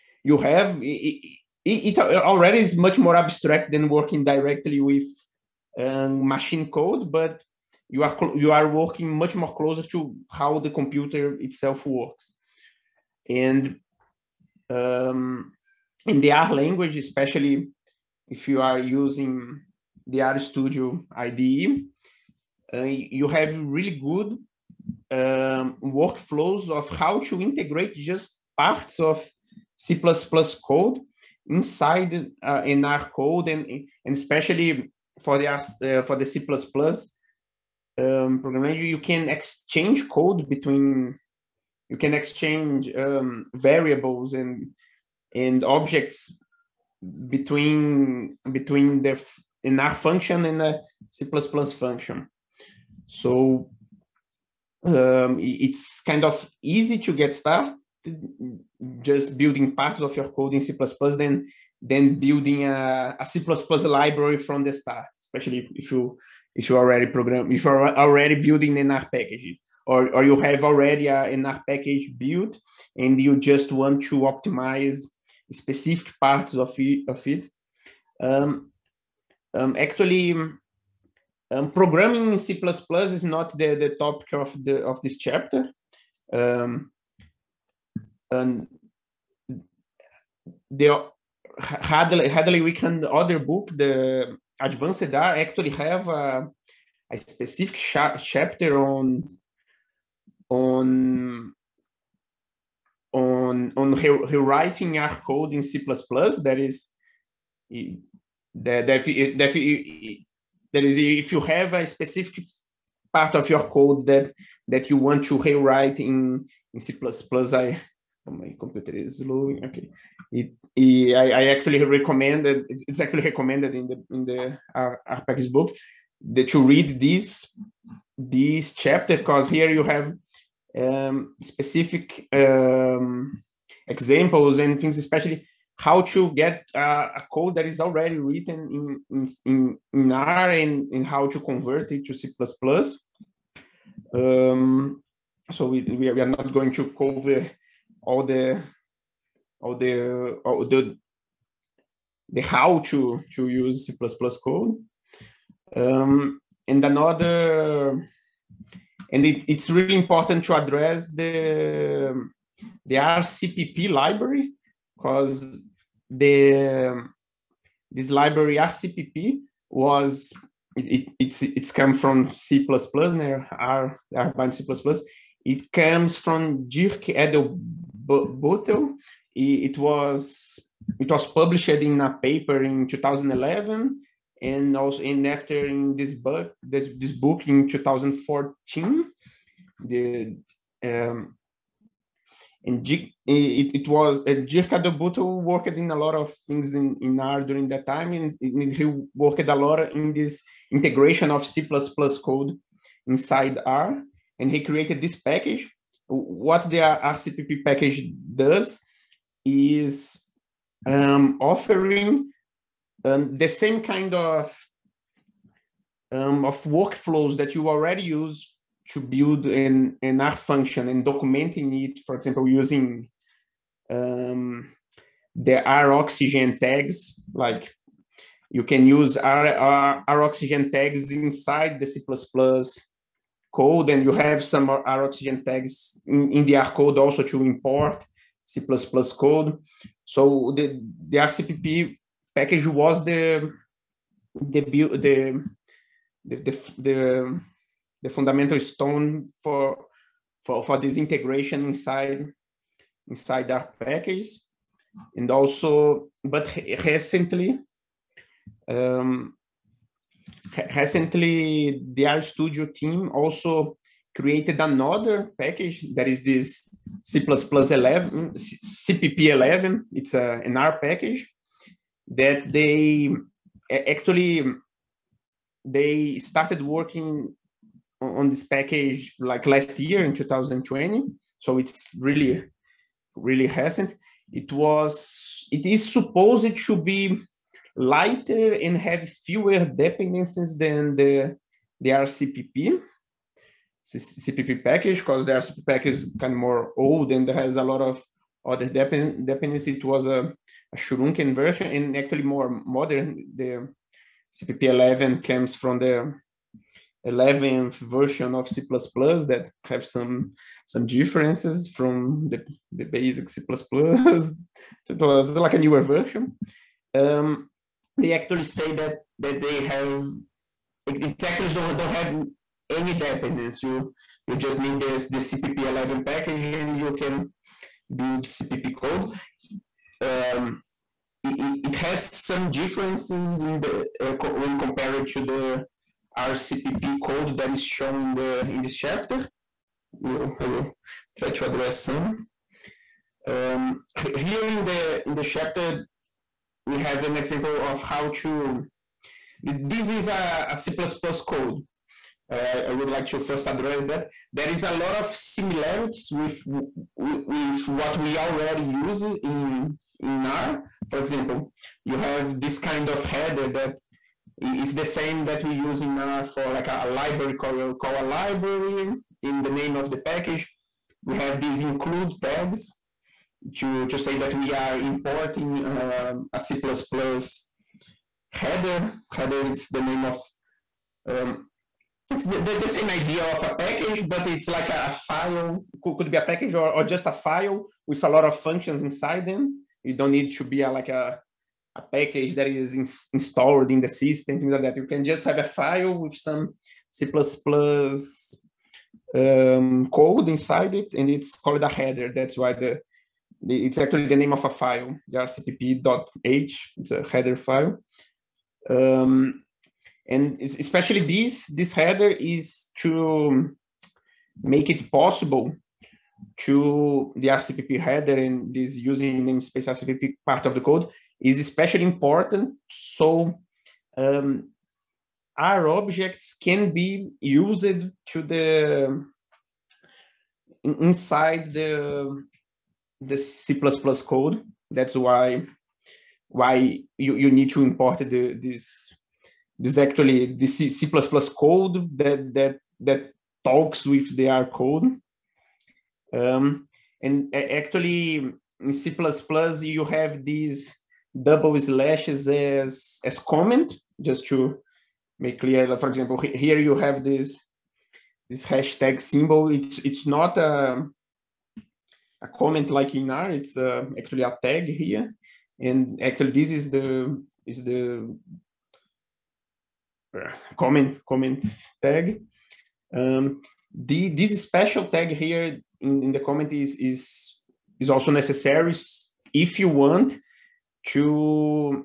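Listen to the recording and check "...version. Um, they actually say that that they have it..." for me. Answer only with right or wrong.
right.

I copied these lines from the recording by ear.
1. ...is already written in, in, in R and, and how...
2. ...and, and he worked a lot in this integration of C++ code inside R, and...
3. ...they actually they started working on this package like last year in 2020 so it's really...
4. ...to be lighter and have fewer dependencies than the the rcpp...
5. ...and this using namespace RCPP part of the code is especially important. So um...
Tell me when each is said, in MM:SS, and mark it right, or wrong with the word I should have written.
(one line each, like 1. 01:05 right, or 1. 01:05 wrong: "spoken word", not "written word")
1. 02:17 right
2. 03:18 right
3. 04:32 right
4. 04:46 right
5. 06:58 right.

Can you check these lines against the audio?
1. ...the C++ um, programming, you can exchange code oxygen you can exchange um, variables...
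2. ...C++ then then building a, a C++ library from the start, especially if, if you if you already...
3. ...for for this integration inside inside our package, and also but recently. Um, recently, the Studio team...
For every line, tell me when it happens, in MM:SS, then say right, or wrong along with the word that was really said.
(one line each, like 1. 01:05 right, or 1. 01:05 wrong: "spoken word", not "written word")
1. 00:36 wrong: "between", not "oxygen"
2. 01:00 right
3. 04:10 right.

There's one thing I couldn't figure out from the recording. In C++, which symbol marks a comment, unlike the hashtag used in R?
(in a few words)
double slashes.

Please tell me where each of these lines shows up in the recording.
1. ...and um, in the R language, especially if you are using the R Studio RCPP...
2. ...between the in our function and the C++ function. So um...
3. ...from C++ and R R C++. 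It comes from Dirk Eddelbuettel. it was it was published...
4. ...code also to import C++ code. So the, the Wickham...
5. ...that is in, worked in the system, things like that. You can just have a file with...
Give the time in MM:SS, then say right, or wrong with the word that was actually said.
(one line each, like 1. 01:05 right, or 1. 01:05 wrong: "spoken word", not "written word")
1. 00:13 wrong: "IDE", not "RCPP"
2. 00:48 right
3. 02:51 right
4. 03:56 wrong: "RCPP", not "Wickham"
5. 06:32 wrong: "installed", not "worked".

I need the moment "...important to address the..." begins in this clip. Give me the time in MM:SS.
02:39.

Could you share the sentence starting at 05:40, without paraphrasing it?
We'll, I will try to address some.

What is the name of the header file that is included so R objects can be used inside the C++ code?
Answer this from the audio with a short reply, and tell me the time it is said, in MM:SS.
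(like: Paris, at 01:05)
Rcpp.h, at 06:45.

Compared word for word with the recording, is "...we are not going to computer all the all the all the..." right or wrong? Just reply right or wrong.
wrong.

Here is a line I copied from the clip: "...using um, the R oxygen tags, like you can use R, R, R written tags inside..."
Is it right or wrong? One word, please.
wrong.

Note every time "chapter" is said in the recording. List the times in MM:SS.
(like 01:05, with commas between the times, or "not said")
01:25, 01:38, 02:08, 05:38, 05:45.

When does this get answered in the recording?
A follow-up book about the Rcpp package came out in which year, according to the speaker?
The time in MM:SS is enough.
03:07.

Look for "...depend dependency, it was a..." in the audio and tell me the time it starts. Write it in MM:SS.
04:58.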